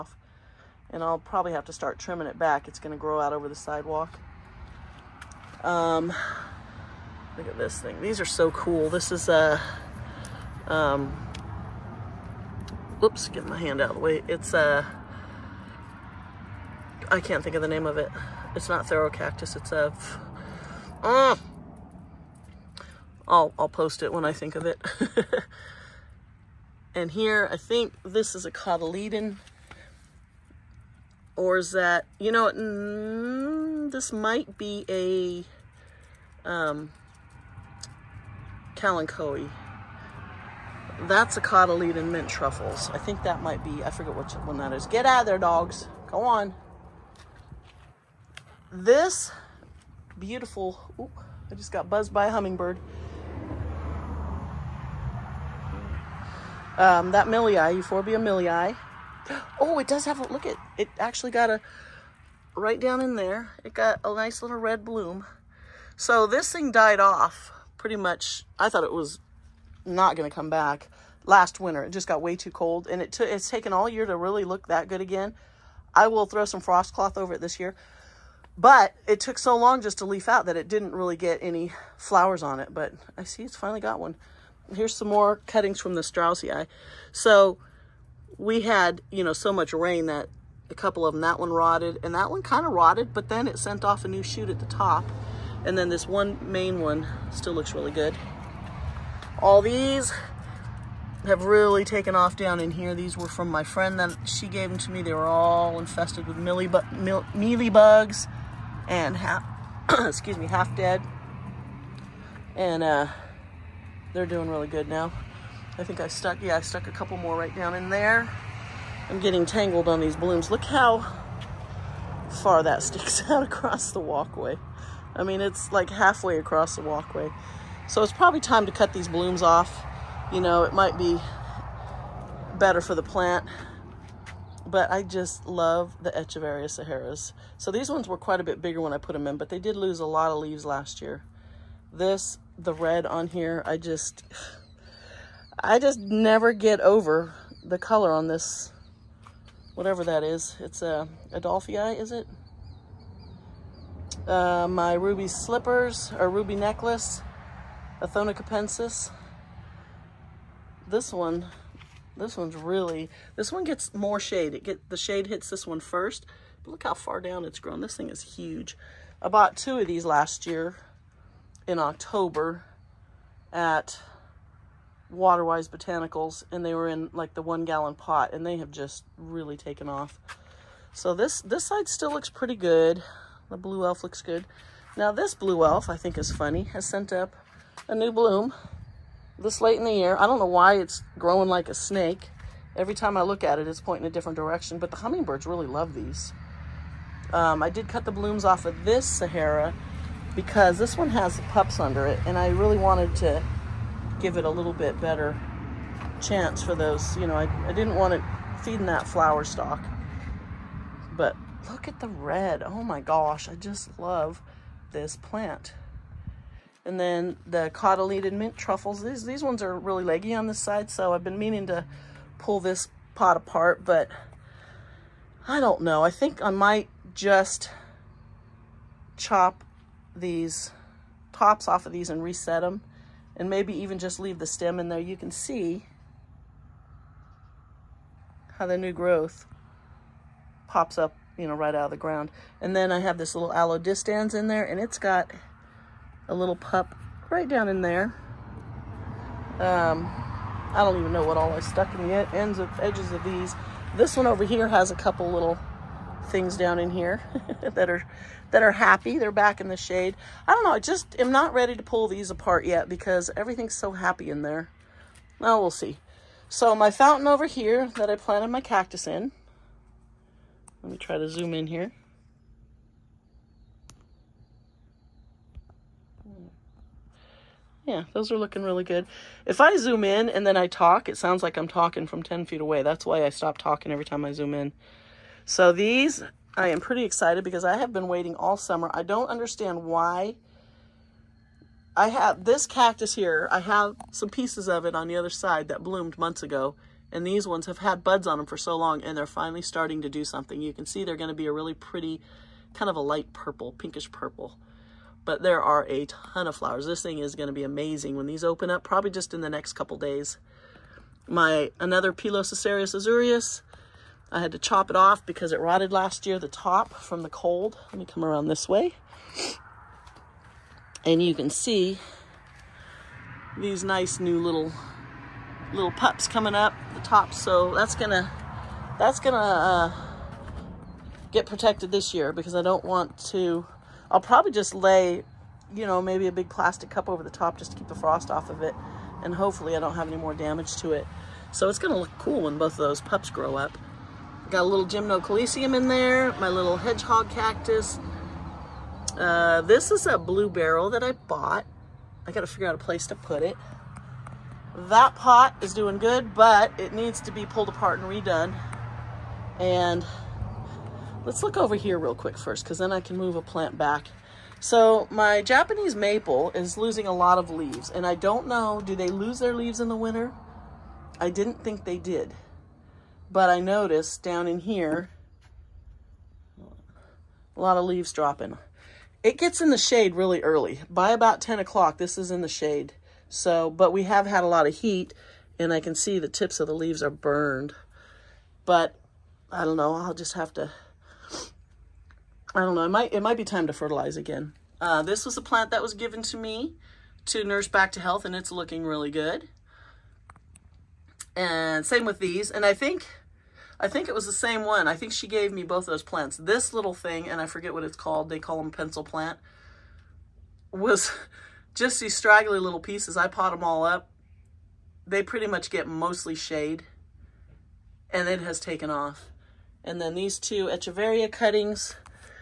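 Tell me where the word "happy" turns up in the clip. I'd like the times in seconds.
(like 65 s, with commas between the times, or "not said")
258 s, 263 s.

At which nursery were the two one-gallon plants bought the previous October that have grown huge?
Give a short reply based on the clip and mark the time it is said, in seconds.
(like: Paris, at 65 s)
Waterwise Botanicals, at 175 s.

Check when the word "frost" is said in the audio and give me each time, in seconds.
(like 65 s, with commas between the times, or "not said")
76 s, 337 s.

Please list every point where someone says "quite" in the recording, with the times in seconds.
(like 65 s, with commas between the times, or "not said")
138 s.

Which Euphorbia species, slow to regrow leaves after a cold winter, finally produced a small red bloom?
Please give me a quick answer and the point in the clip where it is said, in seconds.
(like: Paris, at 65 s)
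Euphorbia millii, at 57 s.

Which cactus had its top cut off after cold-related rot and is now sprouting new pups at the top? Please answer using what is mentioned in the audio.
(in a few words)
Pilosocereus azureus.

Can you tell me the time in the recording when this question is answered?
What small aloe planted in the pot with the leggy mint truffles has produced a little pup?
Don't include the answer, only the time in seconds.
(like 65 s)
243 s.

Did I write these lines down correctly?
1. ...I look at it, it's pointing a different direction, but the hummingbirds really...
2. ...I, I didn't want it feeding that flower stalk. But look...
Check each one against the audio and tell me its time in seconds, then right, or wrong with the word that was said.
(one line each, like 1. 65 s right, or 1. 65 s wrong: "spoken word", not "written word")
1. 193 s right
2. 207 s right.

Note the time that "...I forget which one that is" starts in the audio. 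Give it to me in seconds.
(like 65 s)
43 s.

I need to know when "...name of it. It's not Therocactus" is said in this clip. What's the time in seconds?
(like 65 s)
17 s.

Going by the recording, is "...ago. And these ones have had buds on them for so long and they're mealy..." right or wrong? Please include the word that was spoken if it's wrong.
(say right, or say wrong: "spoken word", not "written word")
wrong: "finally", not "mealy".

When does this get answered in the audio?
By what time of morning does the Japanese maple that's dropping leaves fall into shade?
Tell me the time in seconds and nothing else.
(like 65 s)
381 s.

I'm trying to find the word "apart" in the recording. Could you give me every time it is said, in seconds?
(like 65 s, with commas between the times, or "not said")
223 s, 262 s, 357 s.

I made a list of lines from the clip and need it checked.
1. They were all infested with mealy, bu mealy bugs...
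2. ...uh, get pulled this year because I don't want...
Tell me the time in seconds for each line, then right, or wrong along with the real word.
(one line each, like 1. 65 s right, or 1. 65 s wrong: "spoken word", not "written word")
1. 105 s right
2. 329 s wrong: "protected", not "pulled".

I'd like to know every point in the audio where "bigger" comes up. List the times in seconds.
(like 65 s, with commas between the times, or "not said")
138 s.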